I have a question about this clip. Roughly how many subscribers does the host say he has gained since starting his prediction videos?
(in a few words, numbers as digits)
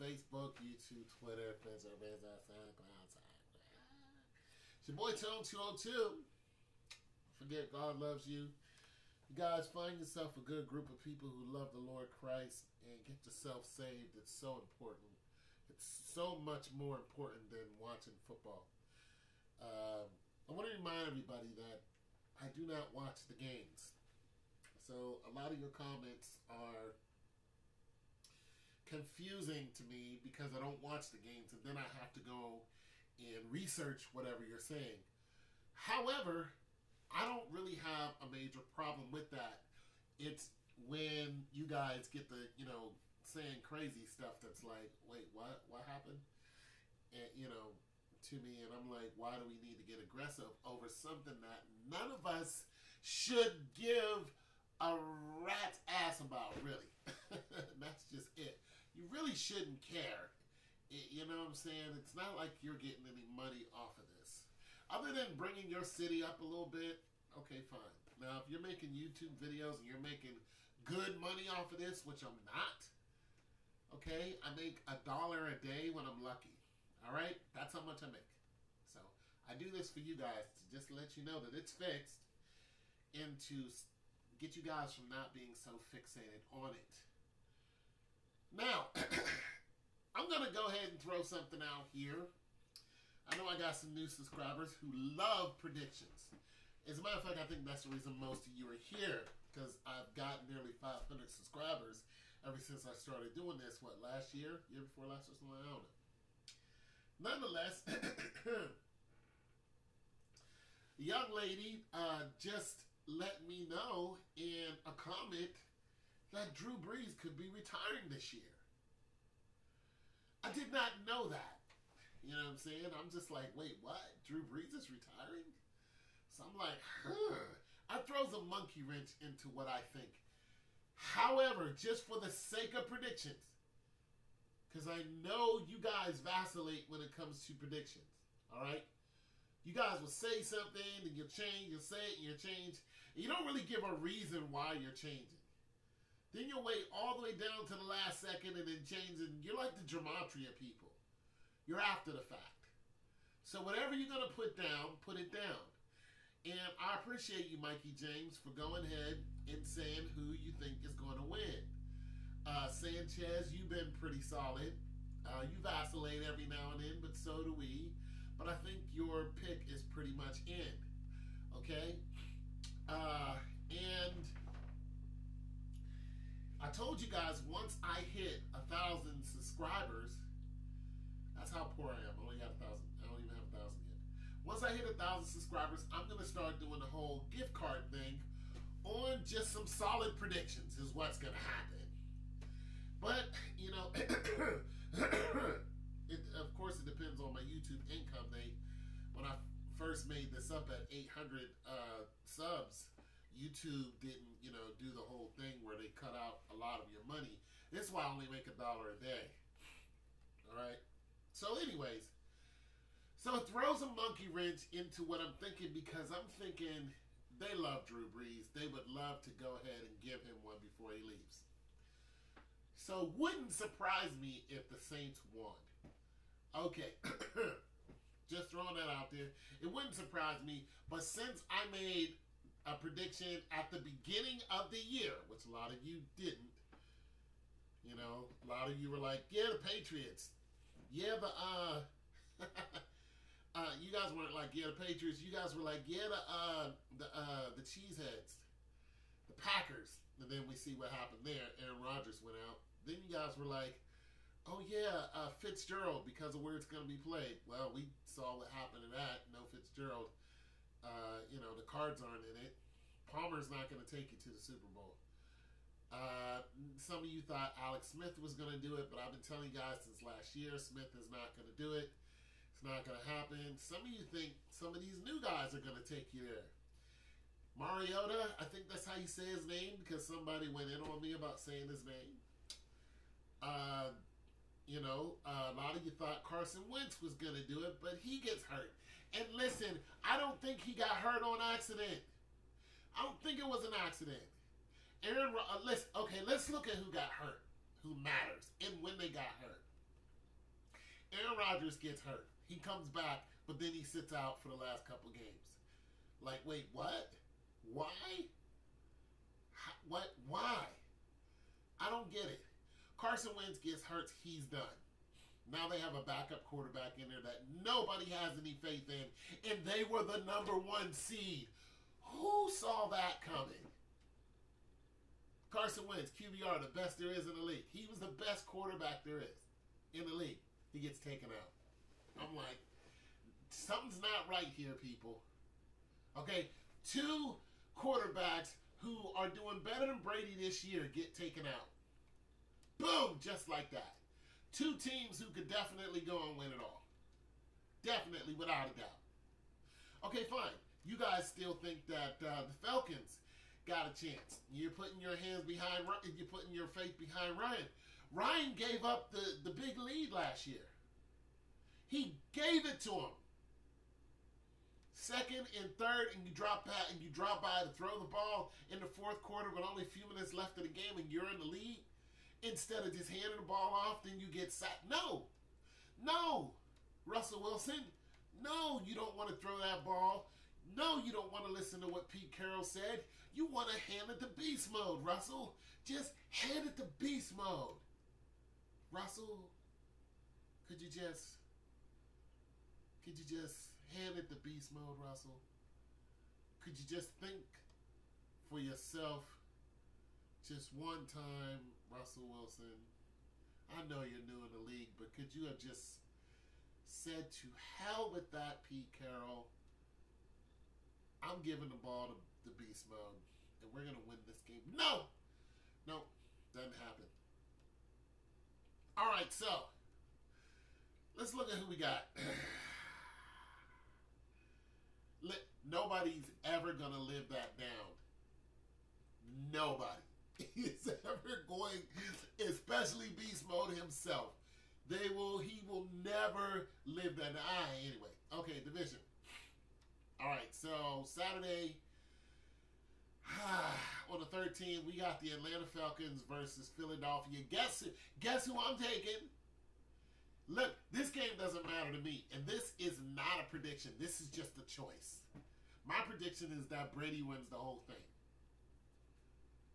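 nearly 500.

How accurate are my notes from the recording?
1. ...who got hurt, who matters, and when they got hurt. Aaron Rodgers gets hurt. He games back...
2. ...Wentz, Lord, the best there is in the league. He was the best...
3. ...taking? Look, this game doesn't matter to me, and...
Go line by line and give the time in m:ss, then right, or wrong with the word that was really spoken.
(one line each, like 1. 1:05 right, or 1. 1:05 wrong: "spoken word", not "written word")
1. 4:56 wrong: "comes", not "games"
2. 5:25 wrong: "QBR", not "Lord"
3. 7:28 right.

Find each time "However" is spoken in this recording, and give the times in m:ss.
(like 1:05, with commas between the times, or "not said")
0:35, 2:10.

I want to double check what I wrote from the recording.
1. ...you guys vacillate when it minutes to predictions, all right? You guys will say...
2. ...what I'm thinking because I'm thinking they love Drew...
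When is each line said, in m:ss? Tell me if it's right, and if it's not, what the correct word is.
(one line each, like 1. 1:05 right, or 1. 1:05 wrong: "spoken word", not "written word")
1. 2:15 wrong: "comes", not "minutes"
2. 3:35 right.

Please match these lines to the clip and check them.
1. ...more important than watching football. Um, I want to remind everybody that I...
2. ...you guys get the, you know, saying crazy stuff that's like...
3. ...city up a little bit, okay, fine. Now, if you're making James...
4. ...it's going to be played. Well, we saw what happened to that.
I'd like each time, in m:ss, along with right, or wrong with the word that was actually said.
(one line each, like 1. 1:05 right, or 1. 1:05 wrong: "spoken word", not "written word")
1. 0:16 right
2. 0:41 right
3. 1:05 wrong: "YouTube", not "James"
4. 4:16 right.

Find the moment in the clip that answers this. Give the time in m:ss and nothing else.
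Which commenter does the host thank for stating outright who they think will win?
2:37.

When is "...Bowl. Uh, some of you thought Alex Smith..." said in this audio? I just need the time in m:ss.
4:24.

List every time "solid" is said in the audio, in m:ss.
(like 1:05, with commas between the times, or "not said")
2:44, 3:09.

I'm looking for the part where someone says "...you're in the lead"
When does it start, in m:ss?
6:11.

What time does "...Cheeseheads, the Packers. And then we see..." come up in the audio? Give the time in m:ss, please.
4:07.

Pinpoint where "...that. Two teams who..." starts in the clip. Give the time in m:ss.
5:43.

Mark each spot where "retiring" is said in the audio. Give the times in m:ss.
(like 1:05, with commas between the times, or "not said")
1:57, 2:04.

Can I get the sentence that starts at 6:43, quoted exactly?
I know you're new in the league, but could you have just said to hell with that, Pete Carroll?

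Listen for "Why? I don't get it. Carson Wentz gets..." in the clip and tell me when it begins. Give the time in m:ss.
5:10.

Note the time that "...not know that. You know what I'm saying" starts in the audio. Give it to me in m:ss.
2:00.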